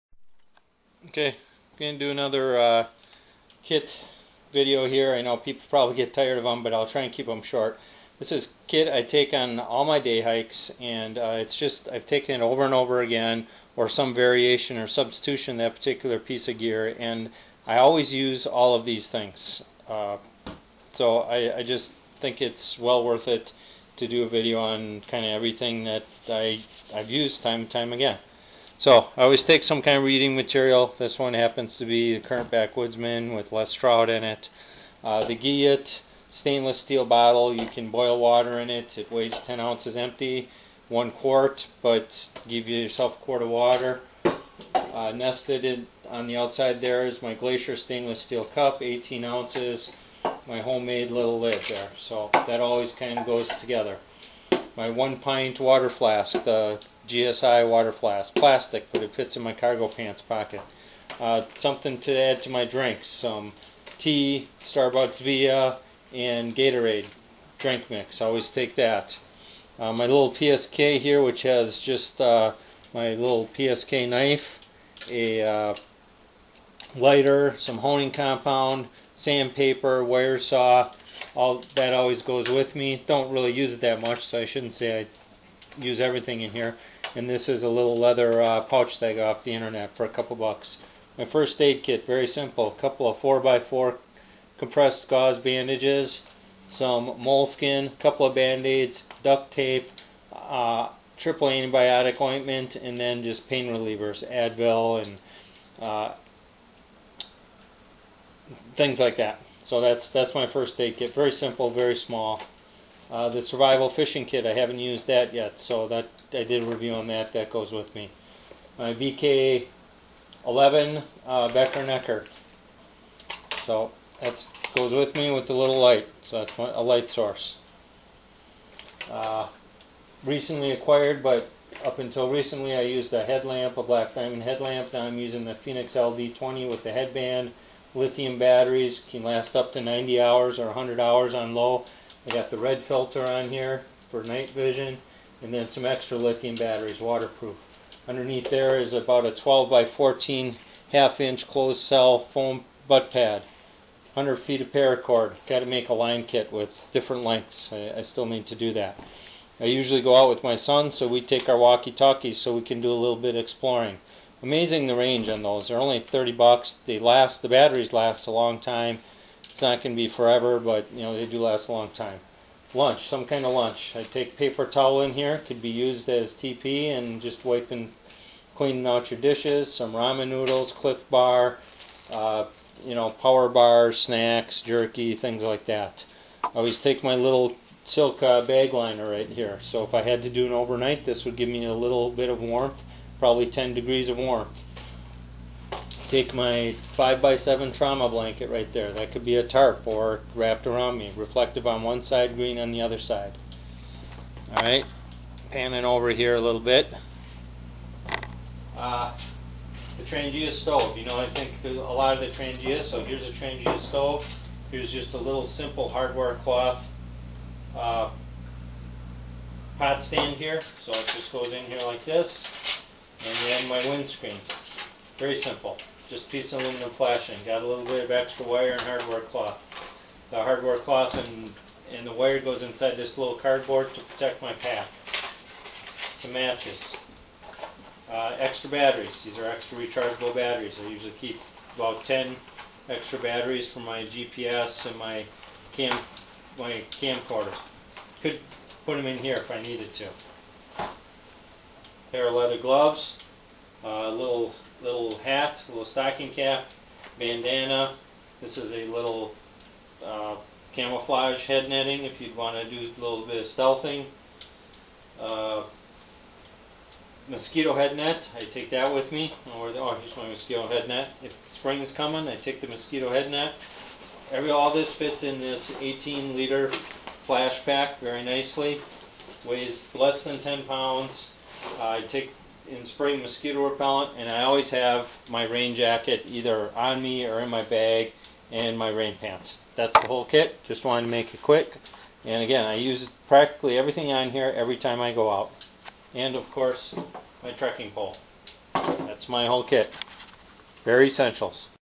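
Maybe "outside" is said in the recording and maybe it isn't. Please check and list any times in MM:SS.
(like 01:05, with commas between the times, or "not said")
00:46.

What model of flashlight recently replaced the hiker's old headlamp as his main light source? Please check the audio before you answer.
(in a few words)
Fenix LD20.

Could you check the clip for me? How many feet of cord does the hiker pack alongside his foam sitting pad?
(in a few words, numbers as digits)
100 feet.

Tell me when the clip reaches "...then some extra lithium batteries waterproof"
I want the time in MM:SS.
02:25.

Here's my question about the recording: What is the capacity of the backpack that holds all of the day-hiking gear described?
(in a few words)
18 liters.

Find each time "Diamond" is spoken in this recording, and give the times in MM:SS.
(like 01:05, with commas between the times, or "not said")
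02:14.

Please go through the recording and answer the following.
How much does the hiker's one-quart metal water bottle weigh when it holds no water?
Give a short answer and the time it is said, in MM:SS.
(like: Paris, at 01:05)
10 ounces, at 00:39.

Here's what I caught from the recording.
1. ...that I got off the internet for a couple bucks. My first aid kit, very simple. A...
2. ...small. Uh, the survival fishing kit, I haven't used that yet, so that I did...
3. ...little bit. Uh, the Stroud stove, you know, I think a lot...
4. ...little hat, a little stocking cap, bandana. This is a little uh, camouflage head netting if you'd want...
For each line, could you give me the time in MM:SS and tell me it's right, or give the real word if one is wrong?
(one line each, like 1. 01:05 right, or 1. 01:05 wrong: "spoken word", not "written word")
1. 01:28 right
2. 01:51 right
3. 03:26 wrong: "Trangia", not "Stroud"
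4. 04:14 right.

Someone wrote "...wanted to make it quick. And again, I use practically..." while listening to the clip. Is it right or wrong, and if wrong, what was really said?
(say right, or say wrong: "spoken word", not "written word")
right.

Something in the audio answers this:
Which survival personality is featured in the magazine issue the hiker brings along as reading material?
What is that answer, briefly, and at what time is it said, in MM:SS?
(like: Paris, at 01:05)
Les Stroud, at 00:33.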